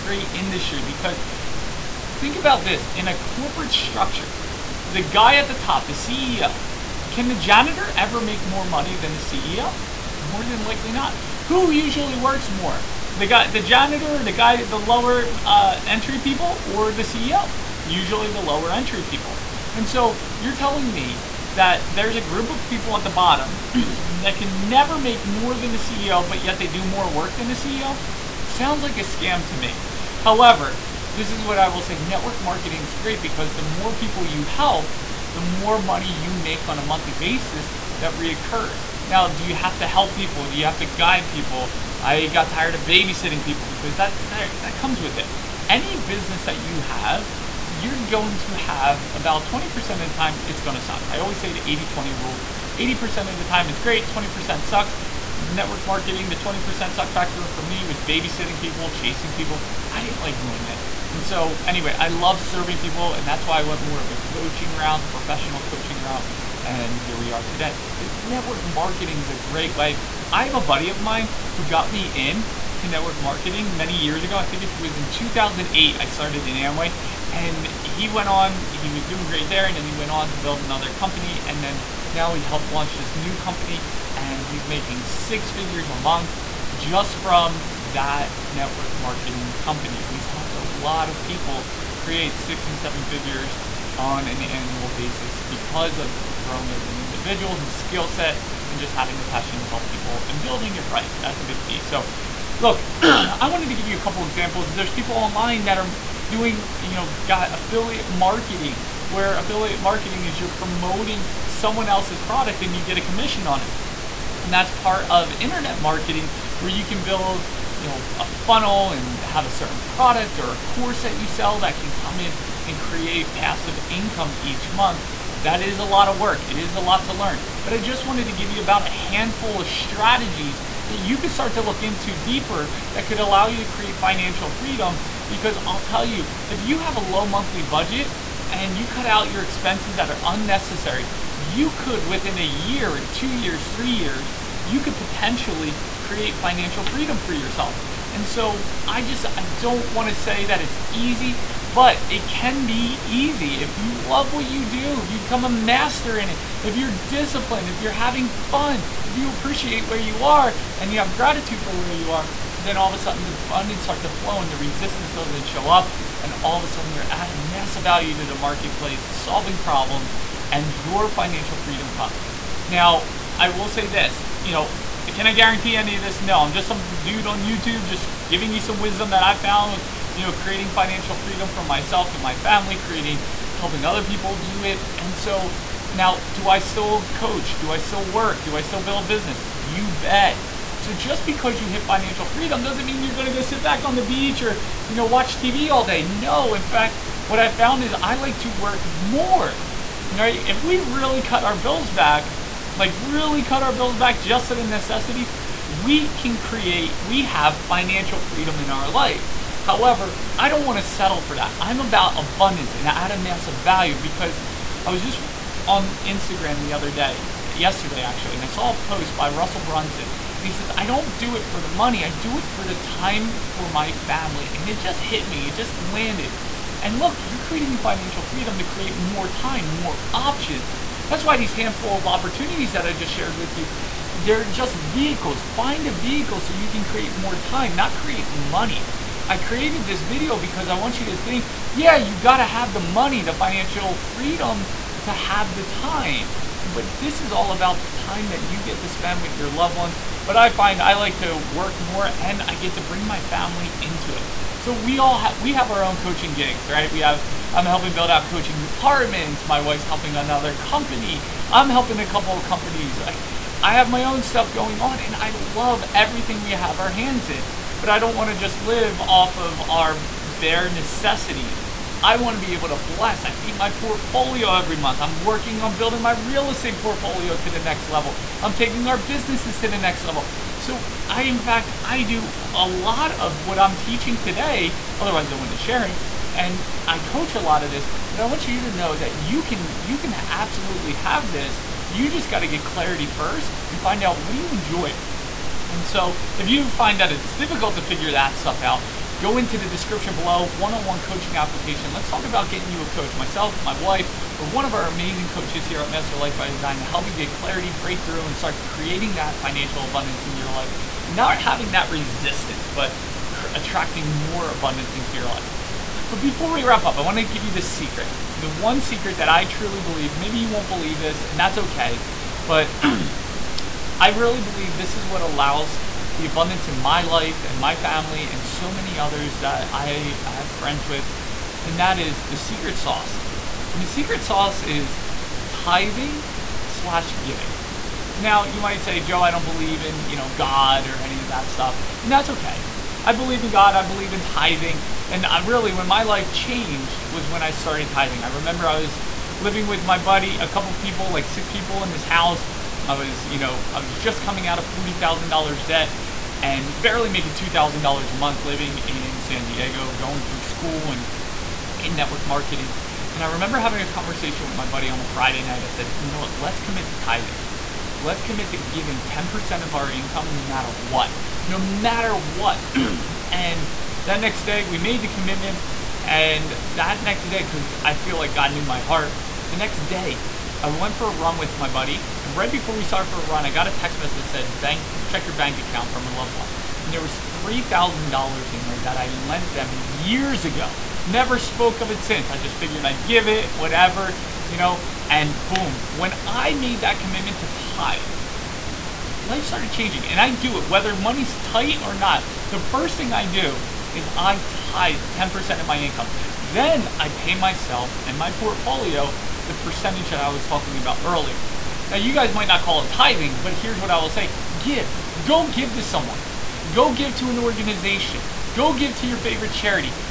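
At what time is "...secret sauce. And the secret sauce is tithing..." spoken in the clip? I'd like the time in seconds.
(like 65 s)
332 s.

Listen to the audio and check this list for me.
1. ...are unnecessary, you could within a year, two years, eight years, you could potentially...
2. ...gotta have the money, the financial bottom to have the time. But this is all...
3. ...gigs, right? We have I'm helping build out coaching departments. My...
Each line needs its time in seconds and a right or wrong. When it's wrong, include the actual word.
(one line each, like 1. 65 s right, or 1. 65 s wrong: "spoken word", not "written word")
1. 140 s wrong: "three", not "eight"
2. 242 s wrong: "freedom", not "bottom"
3. 256 s right.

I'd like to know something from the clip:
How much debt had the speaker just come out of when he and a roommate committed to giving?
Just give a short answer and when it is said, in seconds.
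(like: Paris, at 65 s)
$40,000, at 354 s.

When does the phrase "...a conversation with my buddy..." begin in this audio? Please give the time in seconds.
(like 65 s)
363 s.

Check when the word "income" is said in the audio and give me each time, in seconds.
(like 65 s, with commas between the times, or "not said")
123 s, 369 s, 405 s.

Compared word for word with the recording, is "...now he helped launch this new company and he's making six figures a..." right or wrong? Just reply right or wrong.
right.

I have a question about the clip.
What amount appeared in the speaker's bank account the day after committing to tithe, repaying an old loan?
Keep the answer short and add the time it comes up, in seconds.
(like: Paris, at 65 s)
$3,000, at 387 s.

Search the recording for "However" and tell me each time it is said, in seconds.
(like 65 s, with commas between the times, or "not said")
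30 s, 209 s.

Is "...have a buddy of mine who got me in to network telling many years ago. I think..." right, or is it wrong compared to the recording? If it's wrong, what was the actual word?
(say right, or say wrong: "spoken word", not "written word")
wrong: "marketing", not "telling".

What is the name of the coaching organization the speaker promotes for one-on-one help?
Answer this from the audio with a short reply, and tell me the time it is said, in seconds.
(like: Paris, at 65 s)
Master Life by Design, at 305 s.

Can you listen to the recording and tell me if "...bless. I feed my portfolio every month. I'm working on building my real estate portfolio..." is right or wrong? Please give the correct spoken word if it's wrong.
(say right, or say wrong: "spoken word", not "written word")
right.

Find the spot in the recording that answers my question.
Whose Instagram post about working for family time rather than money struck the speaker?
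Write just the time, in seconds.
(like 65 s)
219 s.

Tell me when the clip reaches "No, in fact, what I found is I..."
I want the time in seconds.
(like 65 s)
196 s.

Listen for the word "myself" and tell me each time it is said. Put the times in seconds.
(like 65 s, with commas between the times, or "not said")
181 s, 303 s, 407 s.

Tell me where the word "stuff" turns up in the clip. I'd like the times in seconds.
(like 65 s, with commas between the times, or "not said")
264 s, 298 s, 341 s.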